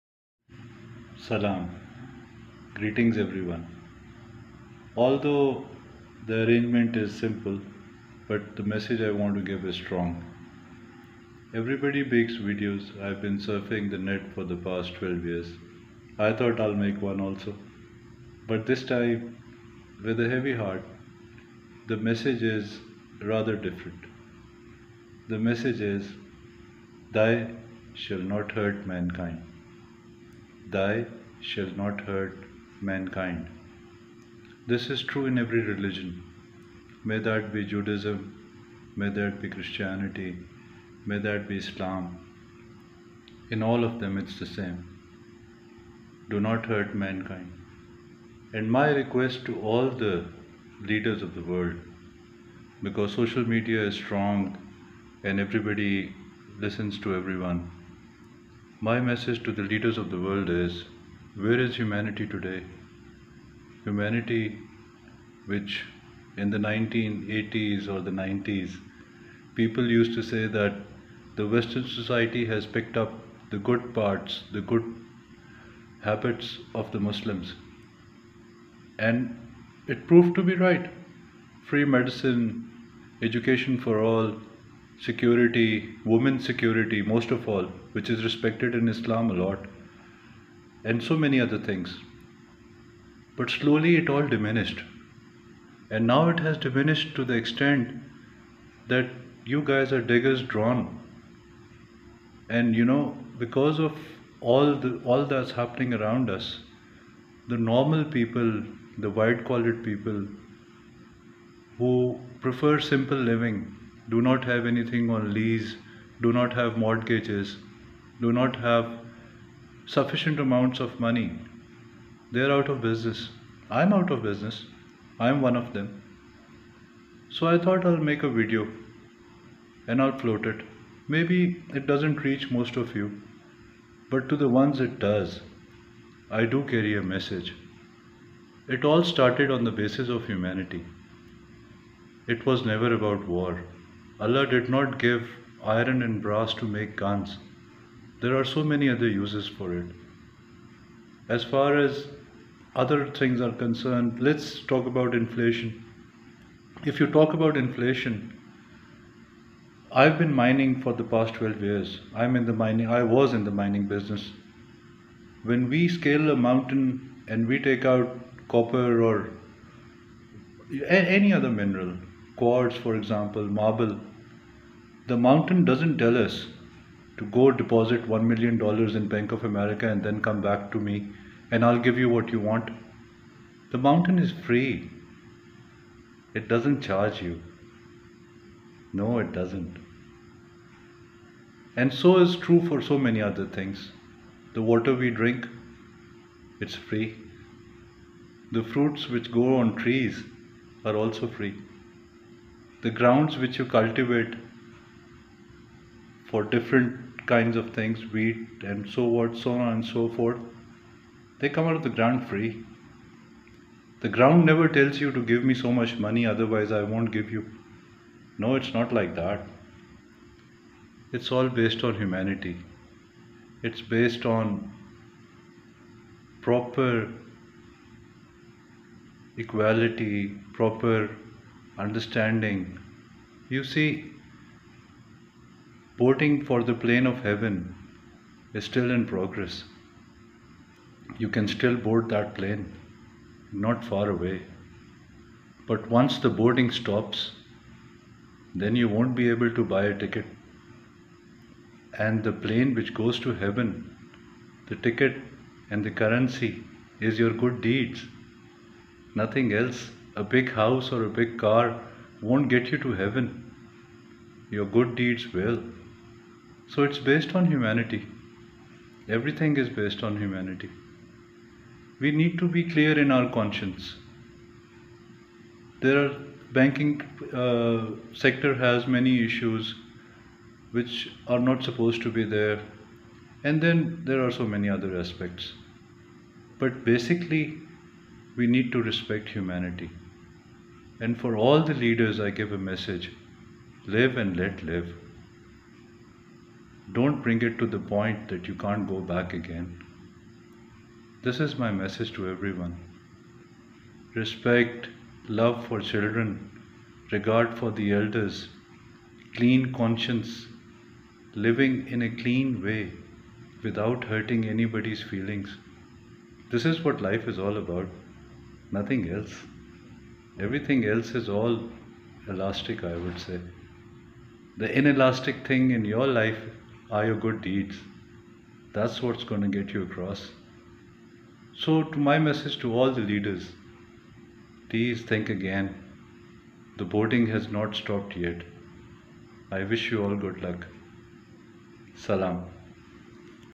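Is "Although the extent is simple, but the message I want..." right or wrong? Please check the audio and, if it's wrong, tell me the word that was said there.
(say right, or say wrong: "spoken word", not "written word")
wrong: "arrangement", not "extent".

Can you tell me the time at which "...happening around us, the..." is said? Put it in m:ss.
1:45.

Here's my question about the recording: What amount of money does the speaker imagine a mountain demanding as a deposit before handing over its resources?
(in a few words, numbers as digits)
$1 million.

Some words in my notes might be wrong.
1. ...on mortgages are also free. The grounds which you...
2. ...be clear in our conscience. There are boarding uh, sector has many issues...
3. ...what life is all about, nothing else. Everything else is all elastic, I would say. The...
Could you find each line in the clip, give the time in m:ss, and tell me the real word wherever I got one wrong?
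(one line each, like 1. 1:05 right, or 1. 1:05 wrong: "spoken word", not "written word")
1. 3:19 wrong: "trees", not "mortgages"
2. 4:32 wrong: "banking", not "boarding"
3. 5:16 right.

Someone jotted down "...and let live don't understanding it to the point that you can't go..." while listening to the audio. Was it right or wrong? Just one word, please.
wrong.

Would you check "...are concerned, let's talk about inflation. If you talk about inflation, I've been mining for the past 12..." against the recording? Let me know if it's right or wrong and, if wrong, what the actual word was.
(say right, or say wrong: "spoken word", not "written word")
right.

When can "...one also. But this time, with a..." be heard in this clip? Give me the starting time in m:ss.
0:17.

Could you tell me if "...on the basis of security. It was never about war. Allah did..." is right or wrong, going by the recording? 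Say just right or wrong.
wrong.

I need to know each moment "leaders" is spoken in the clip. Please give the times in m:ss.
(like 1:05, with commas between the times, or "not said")
0:50, 0:59, 4:51, 5:33.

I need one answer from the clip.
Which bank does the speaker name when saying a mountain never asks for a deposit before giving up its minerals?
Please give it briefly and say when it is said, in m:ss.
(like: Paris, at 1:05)
Bank of America, at 2:59.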